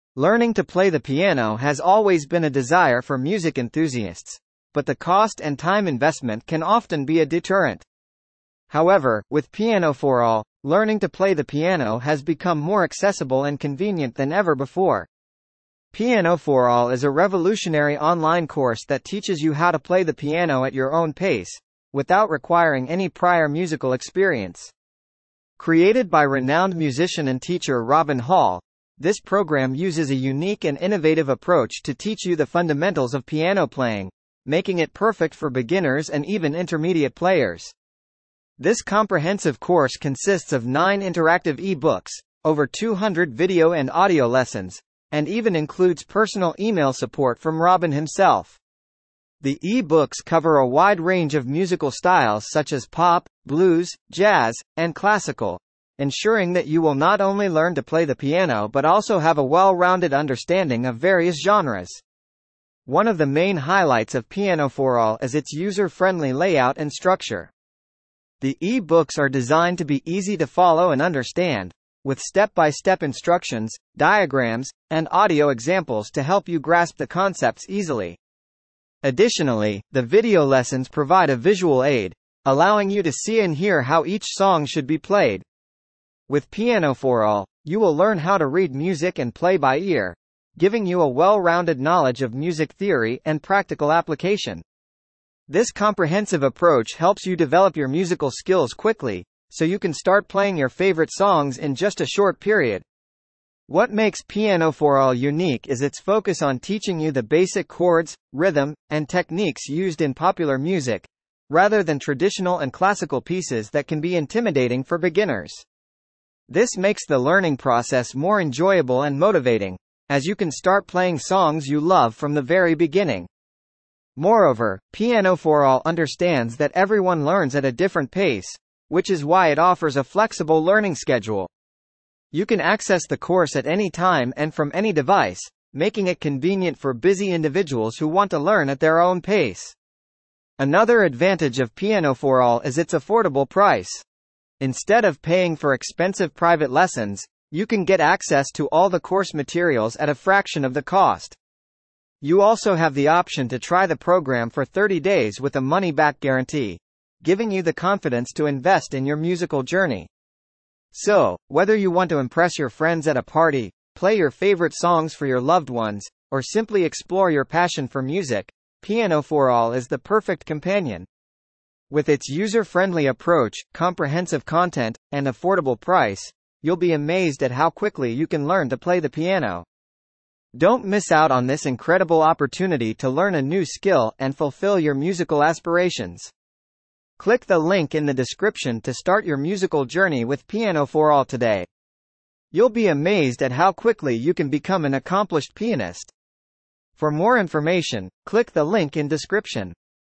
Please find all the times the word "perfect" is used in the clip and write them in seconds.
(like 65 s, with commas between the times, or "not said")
34 s, 169 s.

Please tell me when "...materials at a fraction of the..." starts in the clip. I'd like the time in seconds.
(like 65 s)
149 s.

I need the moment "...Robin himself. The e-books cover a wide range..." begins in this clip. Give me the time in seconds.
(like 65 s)
47 s.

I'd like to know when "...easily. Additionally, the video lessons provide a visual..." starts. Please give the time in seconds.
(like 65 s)
77 s.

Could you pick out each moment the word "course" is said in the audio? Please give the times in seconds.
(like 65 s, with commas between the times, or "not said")
18 s, 39 s, 133 s, 148 s.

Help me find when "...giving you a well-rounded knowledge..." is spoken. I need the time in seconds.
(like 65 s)
90 s.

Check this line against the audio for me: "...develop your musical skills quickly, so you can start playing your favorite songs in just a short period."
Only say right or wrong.
right.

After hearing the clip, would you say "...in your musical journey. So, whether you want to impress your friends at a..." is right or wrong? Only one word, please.
right.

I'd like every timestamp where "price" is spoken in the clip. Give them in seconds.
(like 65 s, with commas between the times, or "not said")
143 s, 175 s.